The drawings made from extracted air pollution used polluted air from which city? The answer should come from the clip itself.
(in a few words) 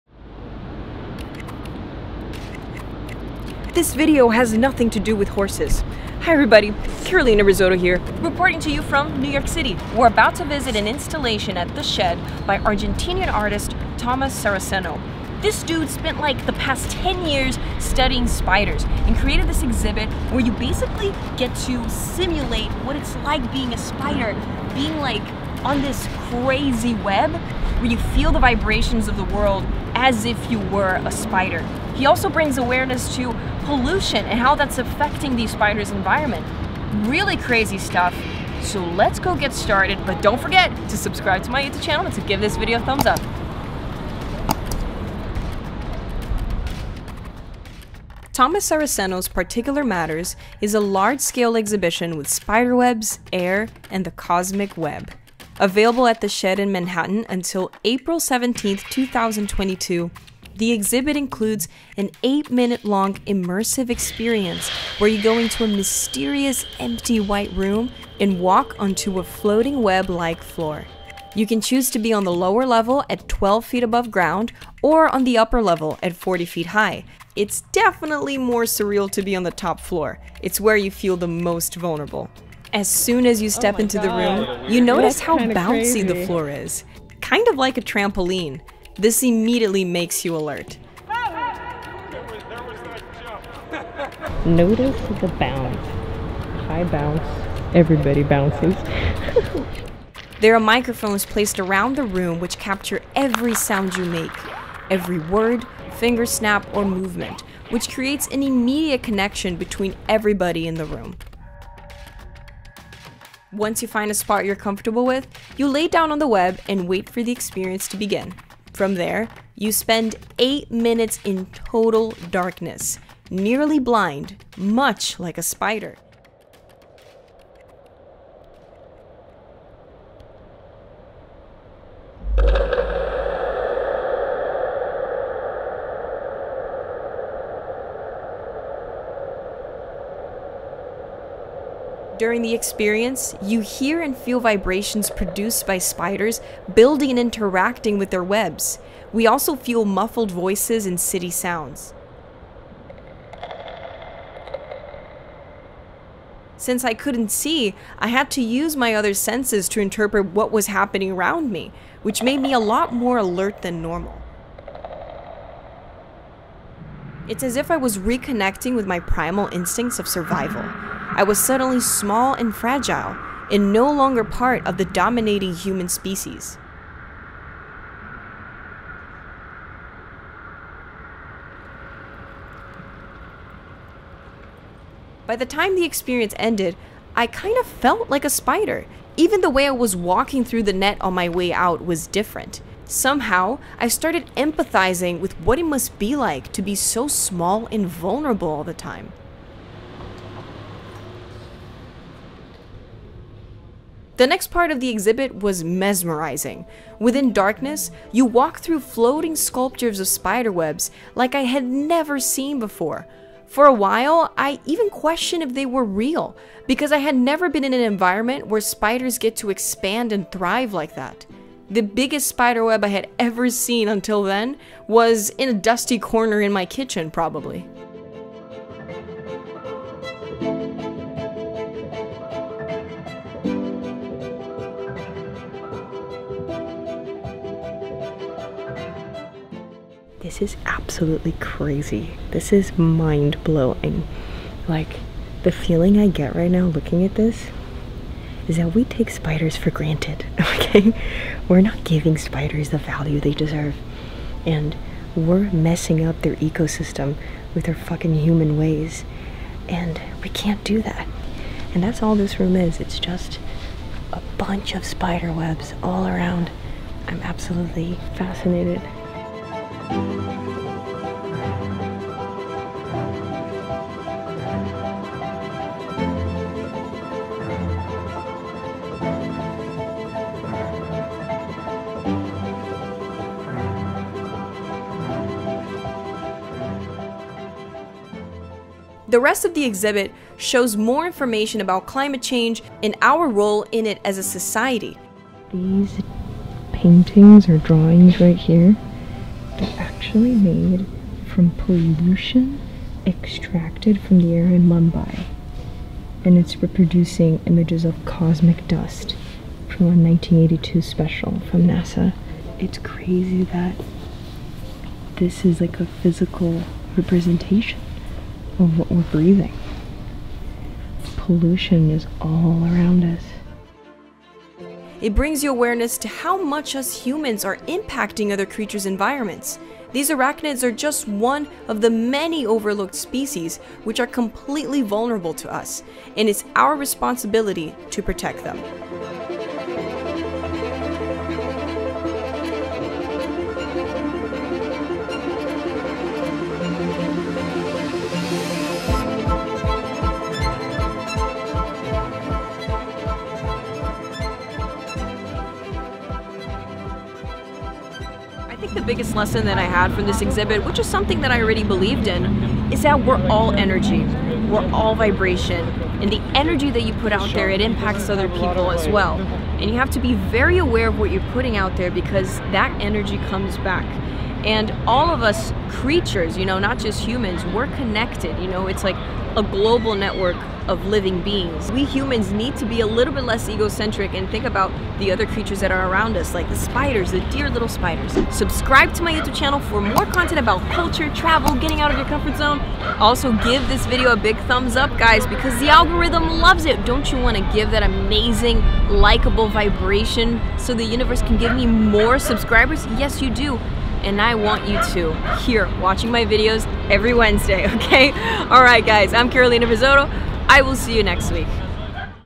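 Mumbai.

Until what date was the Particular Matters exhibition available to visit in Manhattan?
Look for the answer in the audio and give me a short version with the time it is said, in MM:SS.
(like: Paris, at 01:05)
April 17, 2022, at 00:57.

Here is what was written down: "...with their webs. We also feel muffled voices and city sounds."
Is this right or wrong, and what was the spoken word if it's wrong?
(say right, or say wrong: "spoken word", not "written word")
right.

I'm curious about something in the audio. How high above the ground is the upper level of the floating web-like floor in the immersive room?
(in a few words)
40 feet.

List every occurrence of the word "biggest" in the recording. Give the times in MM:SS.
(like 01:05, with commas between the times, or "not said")
03:41, 05:58.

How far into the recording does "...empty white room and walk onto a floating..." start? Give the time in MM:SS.
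01:06.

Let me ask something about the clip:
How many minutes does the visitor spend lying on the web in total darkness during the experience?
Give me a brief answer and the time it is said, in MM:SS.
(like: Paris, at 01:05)
8, at 02:00.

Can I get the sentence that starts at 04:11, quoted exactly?
We're not giving spiders the value they deserve.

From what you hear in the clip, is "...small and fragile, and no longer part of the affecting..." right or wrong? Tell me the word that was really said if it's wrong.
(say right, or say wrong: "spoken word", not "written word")
wrong: "dominating", not "affecting".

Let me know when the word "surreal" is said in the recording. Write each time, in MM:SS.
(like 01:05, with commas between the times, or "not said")
01:18.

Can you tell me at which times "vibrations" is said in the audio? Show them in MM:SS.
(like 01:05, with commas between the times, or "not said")
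00:28, 02:24, 06:04, 06:39.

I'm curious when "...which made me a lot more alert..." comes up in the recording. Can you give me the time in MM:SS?
02:42.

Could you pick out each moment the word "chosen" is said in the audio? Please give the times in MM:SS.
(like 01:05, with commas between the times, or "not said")
not said.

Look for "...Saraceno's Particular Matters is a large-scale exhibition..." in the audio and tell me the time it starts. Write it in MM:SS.
00:48.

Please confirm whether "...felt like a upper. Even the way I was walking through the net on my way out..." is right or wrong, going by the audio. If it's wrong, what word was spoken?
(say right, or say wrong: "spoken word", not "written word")
wrong: "spider", not "upper".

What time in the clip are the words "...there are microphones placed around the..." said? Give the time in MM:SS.
01:40.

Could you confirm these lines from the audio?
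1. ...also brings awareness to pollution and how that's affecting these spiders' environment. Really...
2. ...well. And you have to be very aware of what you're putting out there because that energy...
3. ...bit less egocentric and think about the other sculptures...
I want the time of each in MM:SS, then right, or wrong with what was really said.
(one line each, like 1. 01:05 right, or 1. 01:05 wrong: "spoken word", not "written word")
1. 00:32 right
2. 06:08 right
3. 06:23 wrong: "creatures", not "sculptures".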